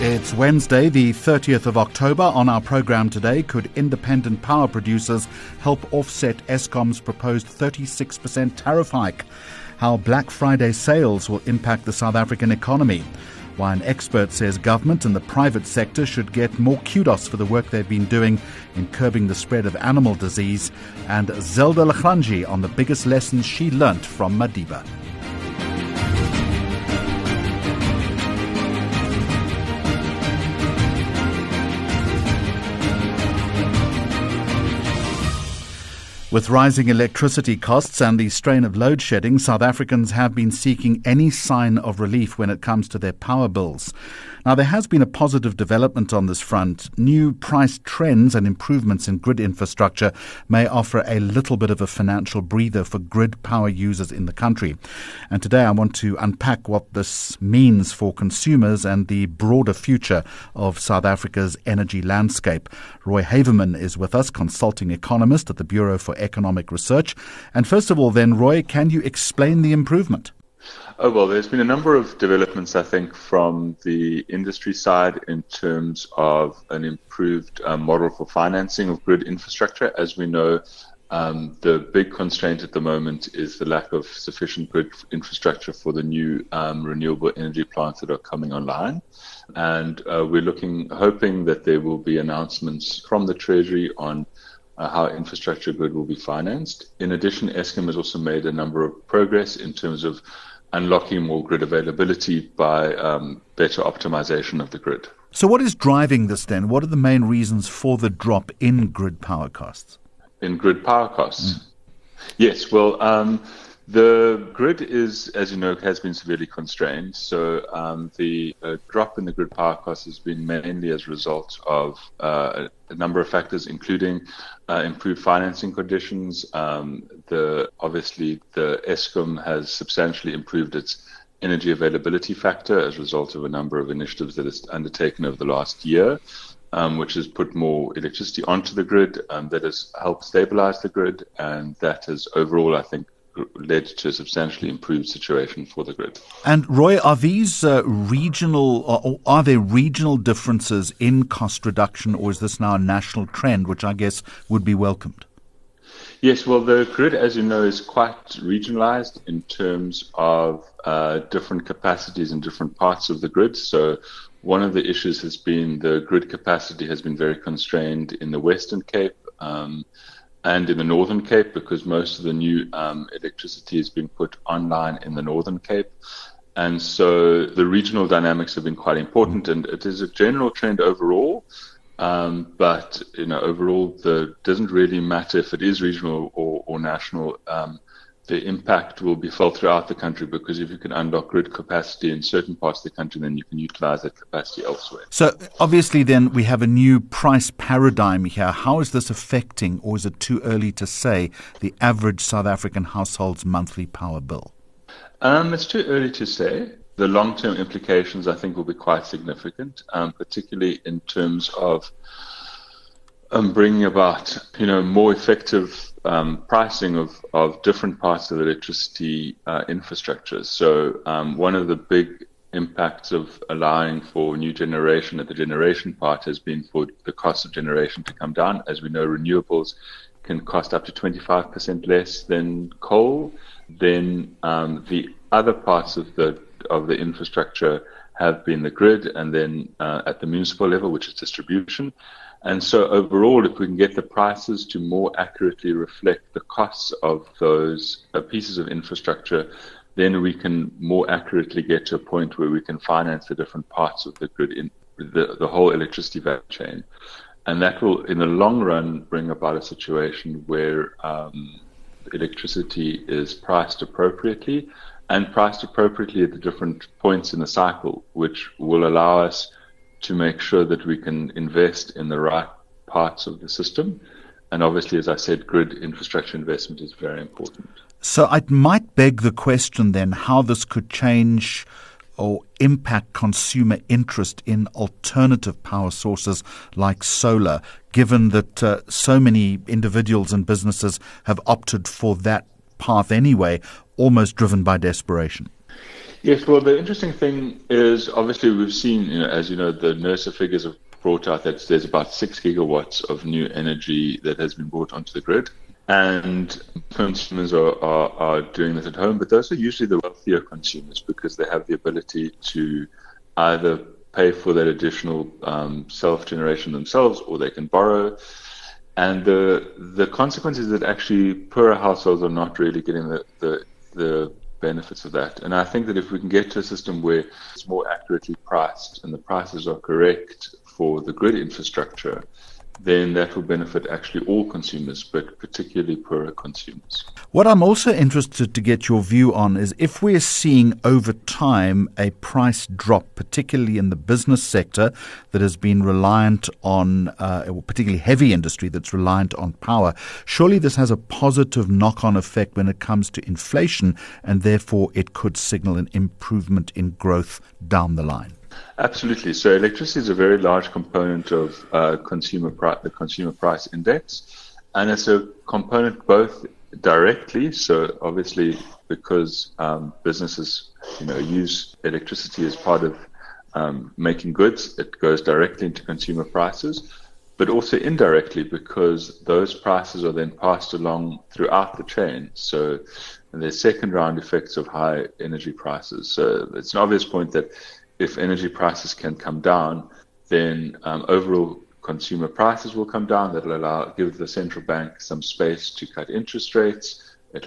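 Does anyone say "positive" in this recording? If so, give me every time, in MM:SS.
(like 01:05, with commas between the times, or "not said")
00:45, 05:50.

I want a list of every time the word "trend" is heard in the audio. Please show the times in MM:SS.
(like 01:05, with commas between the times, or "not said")
00:47, 02:33, 03:00.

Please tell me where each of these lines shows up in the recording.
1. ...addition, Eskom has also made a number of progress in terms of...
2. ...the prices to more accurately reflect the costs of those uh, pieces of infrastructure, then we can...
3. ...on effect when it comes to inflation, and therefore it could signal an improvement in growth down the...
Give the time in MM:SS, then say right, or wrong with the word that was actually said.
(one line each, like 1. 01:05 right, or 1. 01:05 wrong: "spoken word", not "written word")
1. 01:37 right
2. 04:03 right
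3. 05:52 right.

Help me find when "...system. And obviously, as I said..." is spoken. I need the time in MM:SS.
04:33.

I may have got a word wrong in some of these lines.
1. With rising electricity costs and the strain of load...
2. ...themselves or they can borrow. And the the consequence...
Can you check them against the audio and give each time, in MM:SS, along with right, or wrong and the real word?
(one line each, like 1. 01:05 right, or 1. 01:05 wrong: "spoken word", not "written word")
1. 00:36 right
2. 05:16 right.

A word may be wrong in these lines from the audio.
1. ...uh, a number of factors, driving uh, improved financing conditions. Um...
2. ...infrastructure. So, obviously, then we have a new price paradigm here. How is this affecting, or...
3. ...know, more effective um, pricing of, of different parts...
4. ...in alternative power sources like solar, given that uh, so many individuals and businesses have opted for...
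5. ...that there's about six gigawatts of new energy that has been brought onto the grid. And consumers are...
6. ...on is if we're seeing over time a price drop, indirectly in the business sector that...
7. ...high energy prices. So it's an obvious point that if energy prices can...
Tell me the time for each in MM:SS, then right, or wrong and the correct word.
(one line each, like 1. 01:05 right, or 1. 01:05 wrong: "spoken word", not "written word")
1. 02:02 wrong: "including", not "driving"
2. 03:14 wrong: "elsewhere", not "infrastructure"
3. 03:34 right
4. 04:44 right
5. 05:01 right
6. 05:39 wrong: "particularly", not "indirectly"
7. 06:24 right.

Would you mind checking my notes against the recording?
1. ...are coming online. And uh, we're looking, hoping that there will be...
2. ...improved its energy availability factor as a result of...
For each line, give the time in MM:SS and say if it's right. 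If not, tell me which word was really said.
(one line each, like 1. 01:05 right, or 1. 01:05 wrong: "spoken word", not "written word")
1. 01:28 right
2. 02:10 right.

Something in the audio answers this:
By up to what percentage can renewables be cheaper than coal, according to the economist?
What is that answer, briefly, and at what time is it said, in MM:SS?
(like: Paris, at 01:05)
25%, at 03:50.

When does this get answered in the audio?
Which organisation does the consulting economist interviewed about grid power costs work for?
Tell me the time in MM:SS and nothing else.
01:05.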